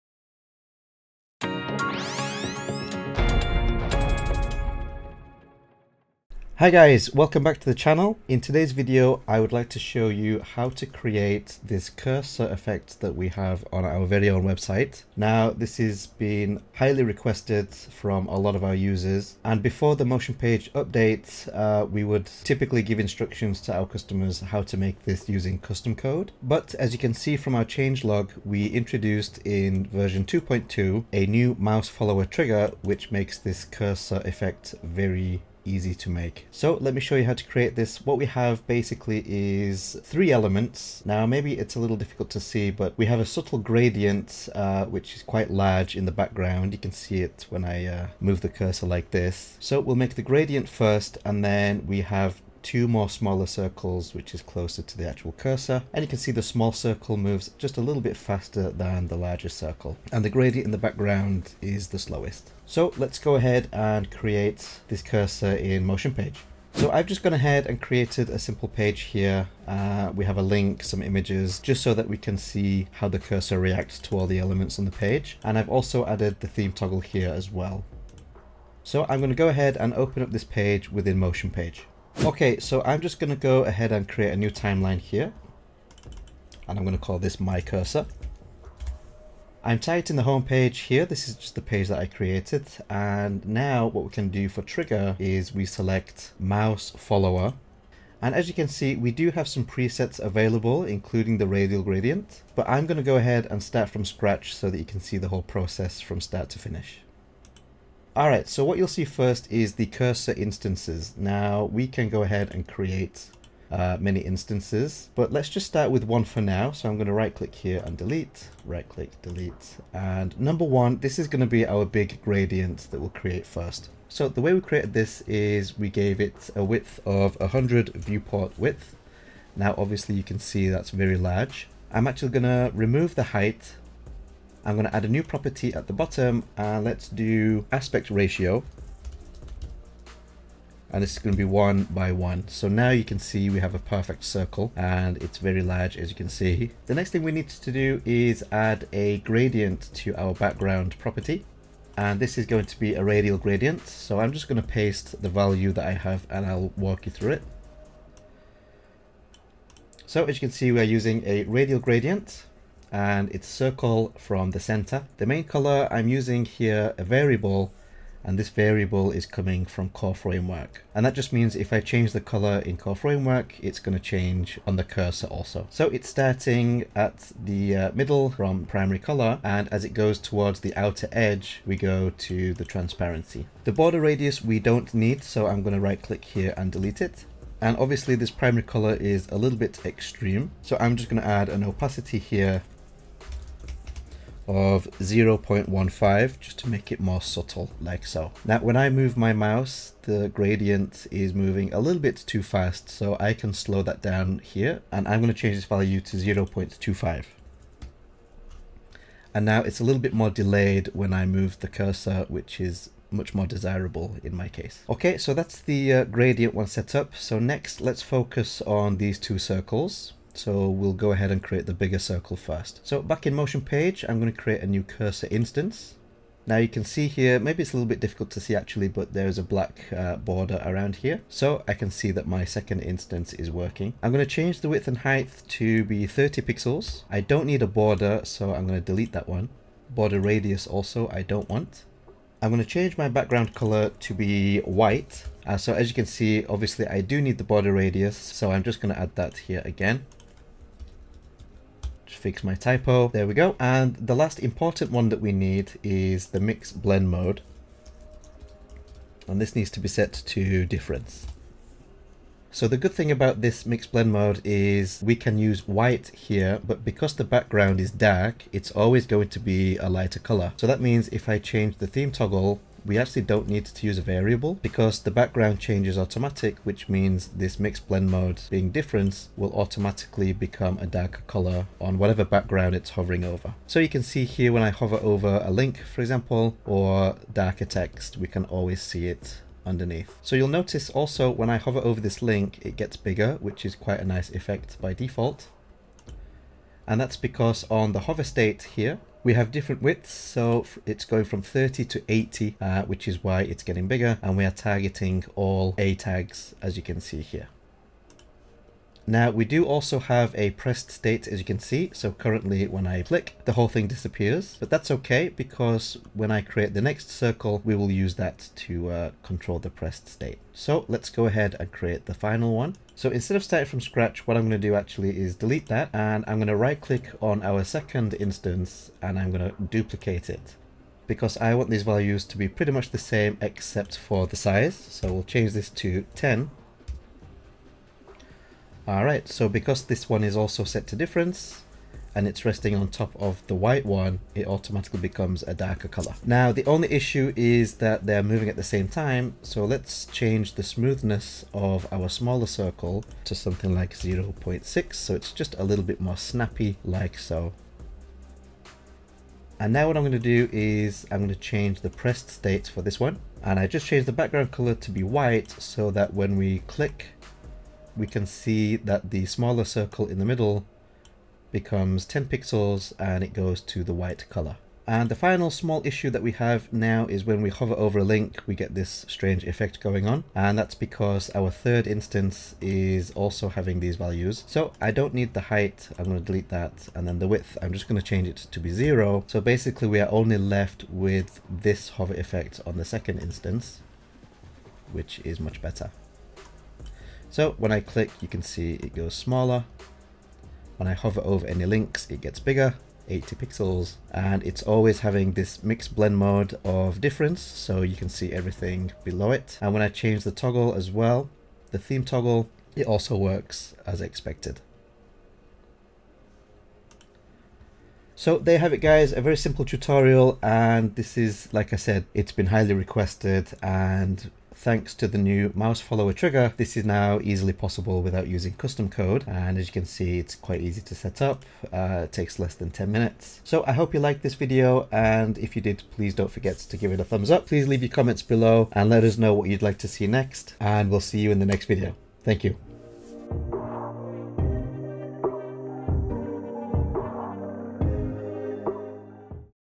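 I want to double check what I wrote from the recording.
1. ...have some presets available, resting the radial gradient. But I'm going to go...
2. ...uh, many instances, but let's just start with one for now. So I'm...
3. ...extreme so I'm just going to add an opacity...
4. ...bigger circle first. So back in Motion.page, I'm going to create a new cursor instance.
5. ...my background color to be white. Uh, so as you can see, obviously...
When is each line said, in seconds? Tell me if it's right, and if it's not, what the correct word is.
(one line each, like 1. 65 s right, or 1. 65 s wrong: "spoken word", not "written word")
1. 99 s wrong: "including", not "resting"
2. 113 s right
3. 189 s right
4. 221 s right
5. 242 s right.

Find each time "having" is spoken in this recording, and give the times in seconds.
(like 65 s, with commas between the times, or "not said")
383 s, 404 s.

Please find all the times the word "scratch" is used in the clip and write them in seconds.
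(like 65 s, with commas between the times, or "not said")
104 s, 323 s.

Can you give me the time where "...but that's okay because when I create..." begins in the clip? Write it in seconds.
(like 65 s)
314 s.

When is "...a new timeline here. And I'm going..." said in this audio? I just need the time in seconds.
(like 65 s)
84 s.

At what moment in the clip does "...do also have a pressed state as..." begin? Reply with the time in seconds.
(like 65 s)
309 s.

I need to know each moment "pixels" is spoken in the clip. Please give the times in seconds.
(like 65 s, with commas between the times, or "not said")
236 s, 372 s, 403 s.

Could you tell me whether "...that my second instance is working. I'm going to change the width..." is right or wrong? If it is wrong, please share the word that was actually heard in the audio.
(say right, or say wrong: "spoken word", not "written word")
right.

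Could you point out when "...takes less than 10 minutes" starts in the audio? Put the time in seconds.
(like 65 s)
432 s.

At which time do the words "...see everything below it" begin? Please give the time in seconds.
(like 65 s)
408 s.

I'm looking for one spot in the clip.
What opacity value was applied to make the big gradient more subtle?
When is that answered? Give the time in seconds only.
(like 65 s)
194 s.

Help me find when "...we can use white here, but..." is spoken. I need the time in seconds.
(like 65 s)
265 s.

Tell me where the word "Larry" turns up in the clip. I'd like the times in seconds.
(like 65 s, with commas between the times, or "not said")
not said.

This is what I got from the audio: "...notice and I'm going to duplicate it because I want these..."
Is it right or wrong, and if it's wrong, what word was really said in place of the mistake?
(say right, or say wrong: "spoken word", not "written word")
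wrong: "instance", not "notice".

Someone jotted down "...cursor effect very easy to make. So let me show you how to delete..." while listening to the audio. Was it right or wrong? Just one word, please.
wrong.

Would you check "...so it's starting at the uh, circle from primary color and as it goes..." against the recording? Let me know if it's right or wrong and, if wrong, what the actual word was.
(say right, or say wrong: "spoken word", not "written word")
wrong: "middle", not "circle".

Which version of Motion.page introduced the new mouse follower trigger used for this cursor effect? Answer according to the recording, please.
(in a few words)
2.2.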